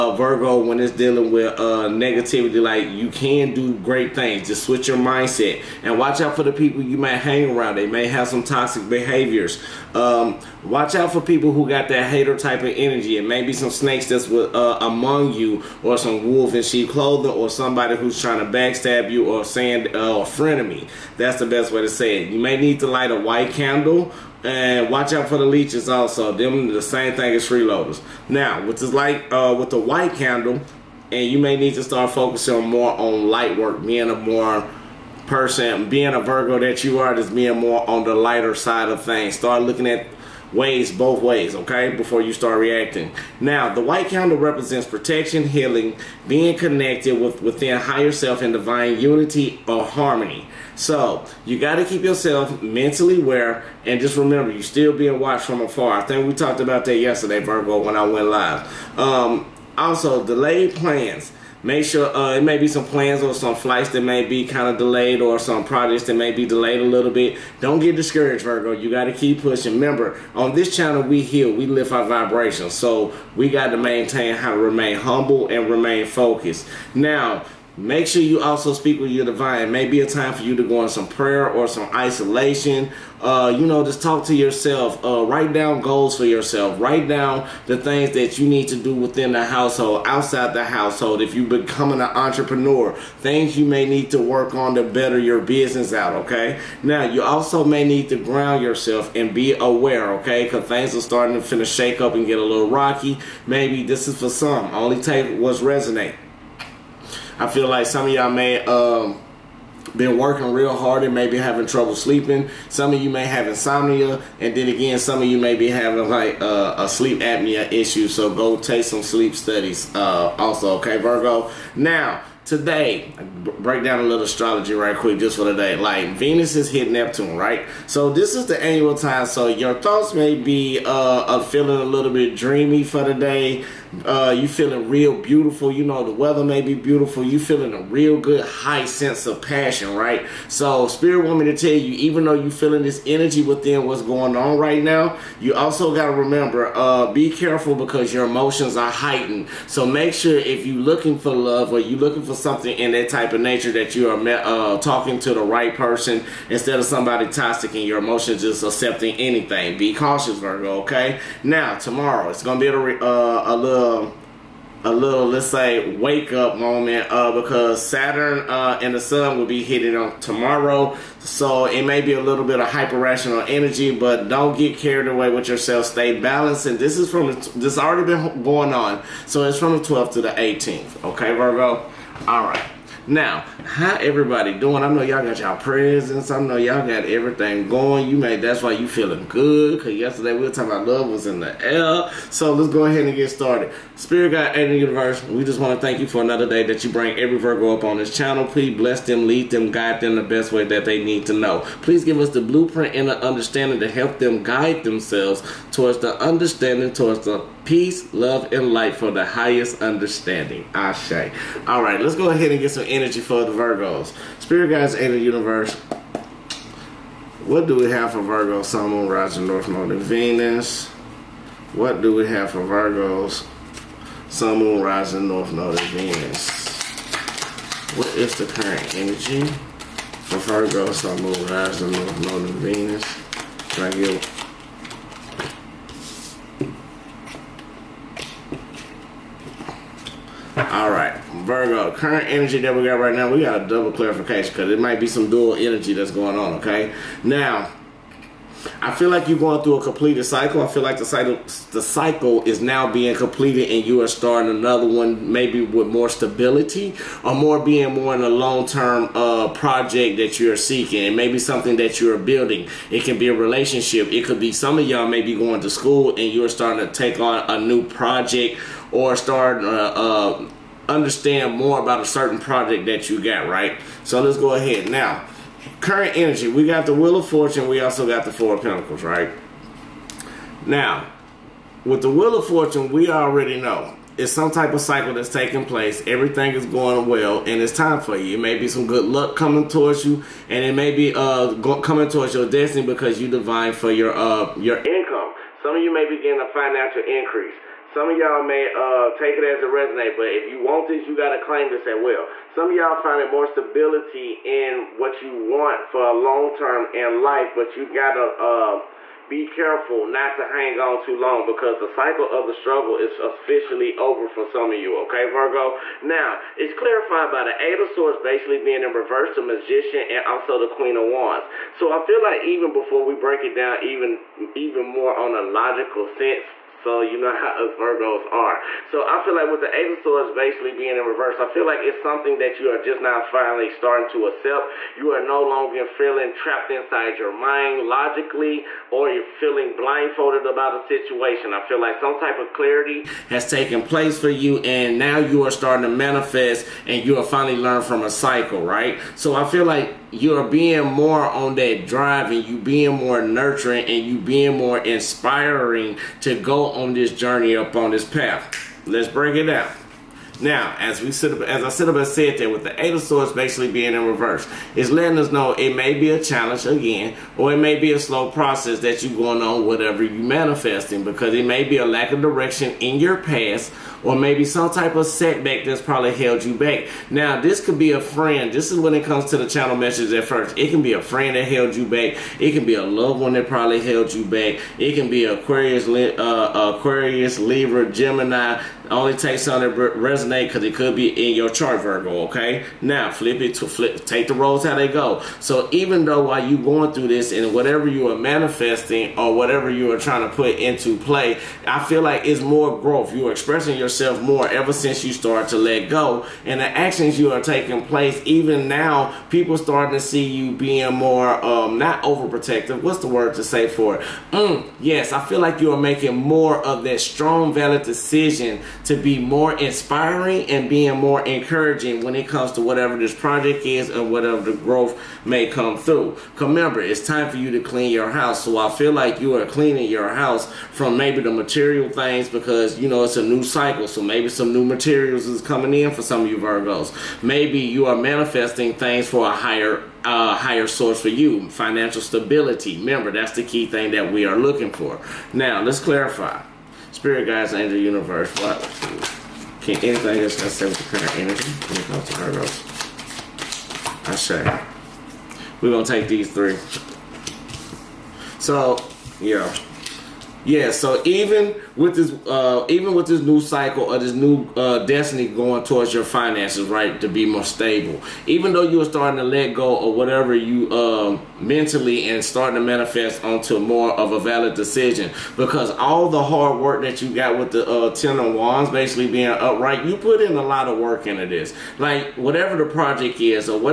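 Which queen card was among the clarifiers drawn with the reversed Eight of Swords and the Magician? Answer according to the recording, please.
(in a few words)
Queen of Wands.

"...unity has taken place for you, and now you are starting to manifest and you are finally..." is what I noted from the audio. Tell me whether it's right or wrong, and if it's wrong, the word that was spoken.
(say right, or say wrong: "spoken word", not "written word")
wrong: "clarity", not "unity".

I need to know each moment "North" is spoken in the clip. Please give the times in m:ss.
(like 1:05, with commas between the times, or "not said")
3:39, 3:45, 3:51.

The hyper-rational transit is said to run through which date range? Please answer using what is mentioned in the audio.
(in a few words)
12th to the 18th.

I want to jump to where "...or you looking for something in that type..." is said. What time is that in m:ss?
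2:31.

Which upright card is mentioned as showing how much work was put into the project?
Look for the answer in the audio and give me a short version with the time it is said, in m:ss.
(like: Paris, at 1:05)
Ten of Wands, at 7:57.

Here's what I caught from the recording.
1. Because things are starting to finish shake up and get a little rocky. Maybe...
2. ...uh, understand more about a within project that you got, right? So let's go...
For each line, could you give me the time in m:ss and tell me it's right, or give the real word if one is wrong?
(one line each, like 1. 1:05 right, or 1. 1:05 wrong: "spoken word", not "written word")
1. 1:40 right
2. 4:29 wrong: "certain", not "within".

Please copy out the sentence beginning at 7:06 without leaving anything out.
Remember, it's time for you to clean your house.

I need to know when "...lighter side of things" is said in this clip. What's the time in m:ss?
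0:38.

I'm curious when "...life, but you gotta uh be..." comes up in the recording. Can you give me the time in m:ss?
5:07.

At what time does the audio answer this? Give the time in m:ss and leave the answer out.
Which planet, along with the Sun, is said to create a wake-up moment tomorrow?
2:47.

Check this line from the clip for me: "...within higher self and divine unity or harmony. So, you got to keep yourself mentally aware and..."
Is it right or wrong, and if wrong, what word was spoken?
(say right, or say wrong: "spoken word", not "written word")
right.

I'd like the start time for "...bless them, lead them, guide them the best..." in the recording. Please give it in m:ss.
3:18.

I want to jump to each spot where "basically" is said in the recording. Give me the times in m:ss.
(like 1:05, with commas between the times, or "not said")
5:18, 5:30, 6:03, 7:58.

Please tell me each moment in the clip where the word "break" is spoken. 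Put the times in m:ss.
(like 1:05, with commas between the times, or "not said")
2:03, 5:23, 5:59.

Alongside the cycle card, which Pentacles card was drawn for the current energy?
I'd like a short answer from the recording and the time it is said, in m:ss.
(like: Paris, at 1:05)
Four of Pentacles, at 4:38.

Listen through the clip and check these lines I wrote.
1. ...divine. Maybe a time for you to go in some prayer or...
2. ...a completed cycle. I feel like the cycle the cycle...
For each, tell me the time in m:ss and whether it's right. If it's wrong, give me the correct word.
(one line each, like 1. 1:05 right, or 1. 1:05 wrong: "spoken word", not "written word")
1. 1:19 right
2. 4:09 right.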